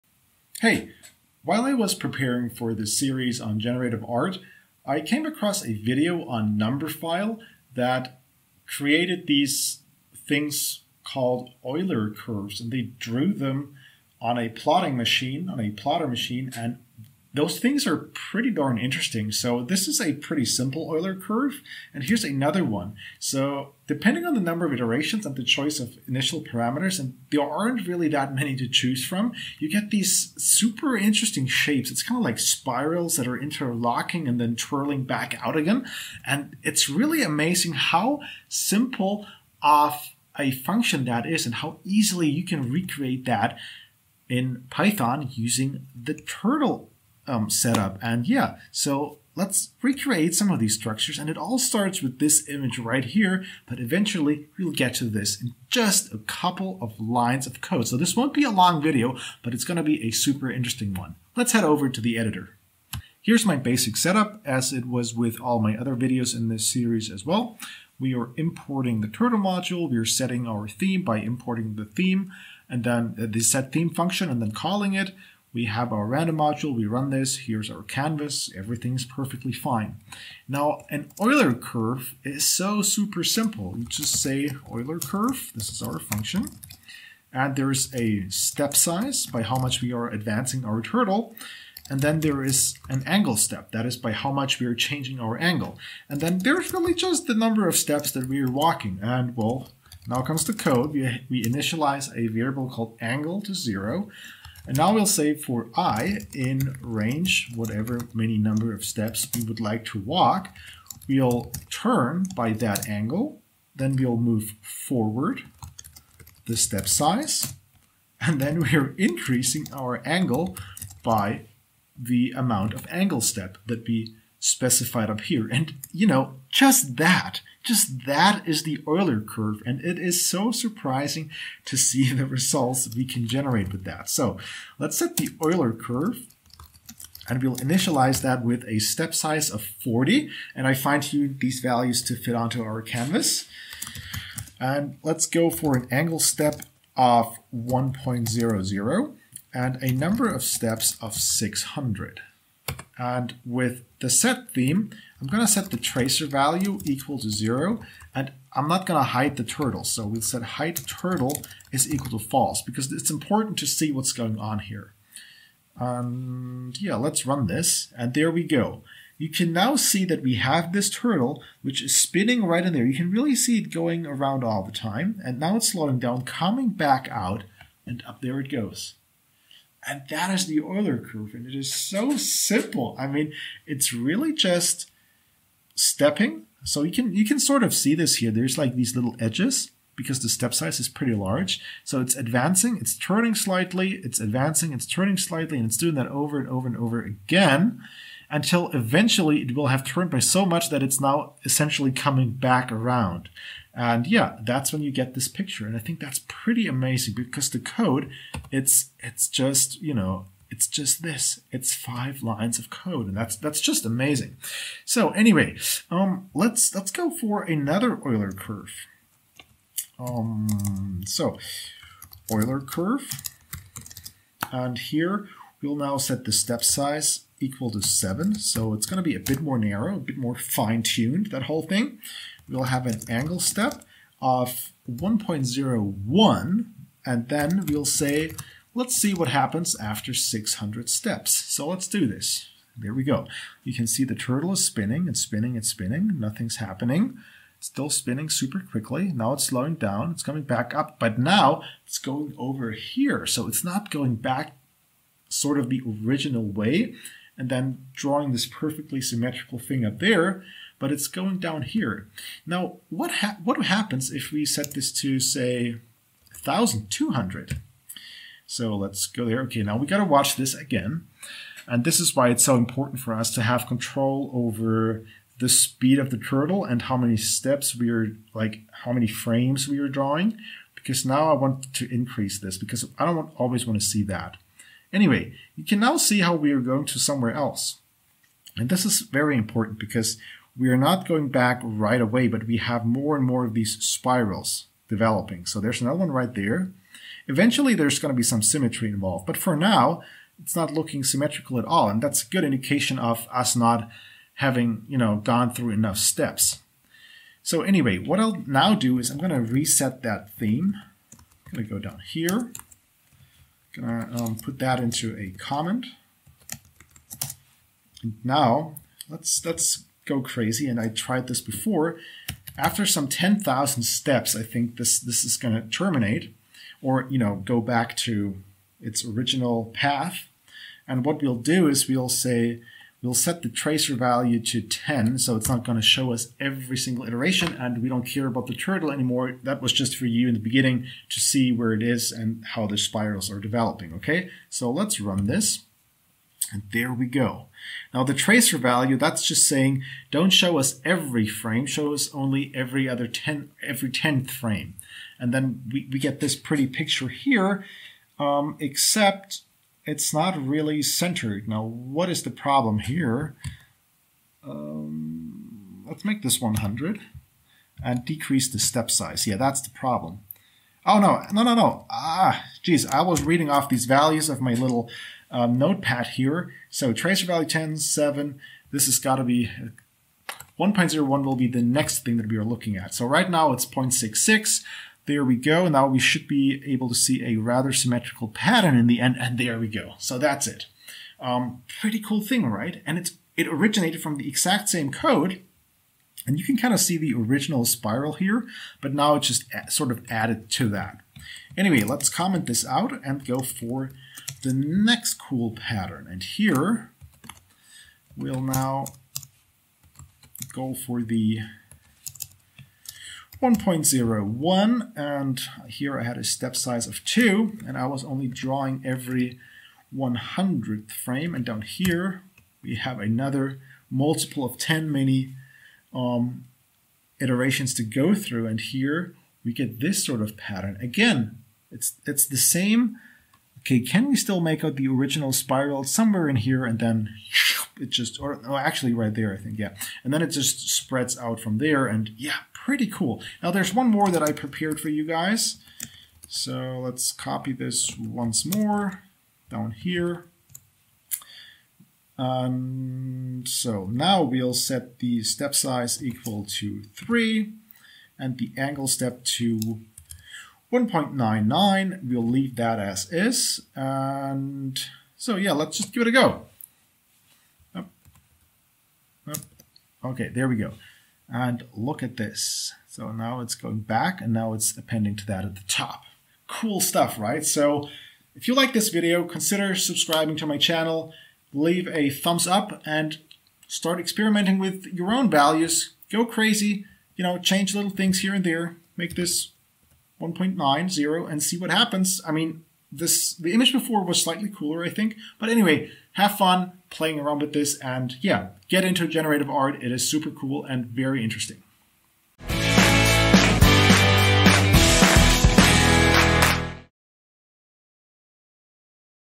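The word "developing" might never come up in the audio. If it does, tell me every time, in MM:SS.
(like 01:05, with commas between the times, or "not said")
04:54, 05:43.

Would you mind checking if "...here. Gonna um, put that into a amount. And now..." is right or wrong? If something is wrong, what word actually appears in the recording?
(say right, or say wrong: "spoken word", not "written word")
wrong: "comment", not "amount".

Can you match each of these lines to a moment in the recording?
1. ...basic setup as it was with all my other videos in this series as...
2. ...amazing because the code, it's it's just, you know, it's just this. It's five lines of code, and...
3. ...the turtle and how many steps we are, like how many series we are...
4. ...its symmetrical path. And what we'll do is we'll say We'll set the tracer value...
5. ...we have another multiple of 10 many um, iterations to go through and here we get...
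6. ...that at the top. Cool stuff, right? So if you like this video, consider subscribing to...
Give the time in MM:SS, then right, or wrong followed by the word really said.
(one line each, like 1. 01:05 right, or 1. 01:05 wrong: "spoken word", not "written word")
1. 01:03 right
2. 03:26 right
3. 04:36 wrong: "frames", not "series"
4. 05:28 wrong: "original", not "symmetrical"
5. 07:02 right
6. 07:55 right.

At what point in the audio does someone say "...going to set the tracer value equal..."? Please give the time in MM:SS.
02:35.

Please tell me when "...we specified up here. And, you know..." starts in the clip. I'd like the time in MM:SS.
02:03.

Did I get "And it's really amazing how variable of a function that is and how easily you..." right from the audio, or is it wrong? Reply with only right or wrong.
wrong.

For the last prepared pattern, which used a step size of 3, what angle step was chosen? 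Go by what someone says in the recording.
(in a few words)
1.99.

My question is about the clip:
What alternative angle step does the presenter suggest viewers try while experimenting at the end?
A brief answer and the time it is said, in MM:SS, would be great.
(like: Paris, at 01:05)
1.90, at 08:10.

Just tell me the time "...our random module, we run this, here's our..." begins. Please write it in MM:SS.
01:15.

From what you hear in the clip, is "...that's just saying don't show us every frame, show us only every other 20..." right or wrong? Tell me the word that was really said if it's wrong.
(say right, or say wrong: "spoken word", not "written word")
wrong: "10", not "20".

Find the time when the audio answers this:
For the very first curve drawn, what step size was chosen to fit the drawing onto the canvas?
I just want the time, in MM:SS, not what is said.
02:19.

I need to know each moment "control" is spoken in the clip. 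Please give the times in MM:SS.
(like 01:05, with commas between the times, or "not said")
04:33.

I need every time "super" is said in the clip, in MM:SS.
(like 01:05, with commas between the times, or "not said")
00:30, 01:00, 01:22, 04:08, 08:20.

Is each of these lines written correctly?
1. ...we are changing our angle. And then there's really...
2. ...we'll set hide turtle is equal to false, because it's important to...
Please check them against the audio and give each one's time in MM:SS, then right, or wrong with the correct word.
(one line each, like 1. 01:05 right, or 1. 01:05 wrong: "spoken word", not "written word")
1. 01:34 right
2. 02:40 right.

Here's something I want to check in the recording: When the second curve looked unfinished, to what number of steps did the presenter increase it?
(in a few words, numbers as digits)
1,200.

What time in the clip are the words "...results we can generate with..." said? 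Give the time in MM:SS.
02:12.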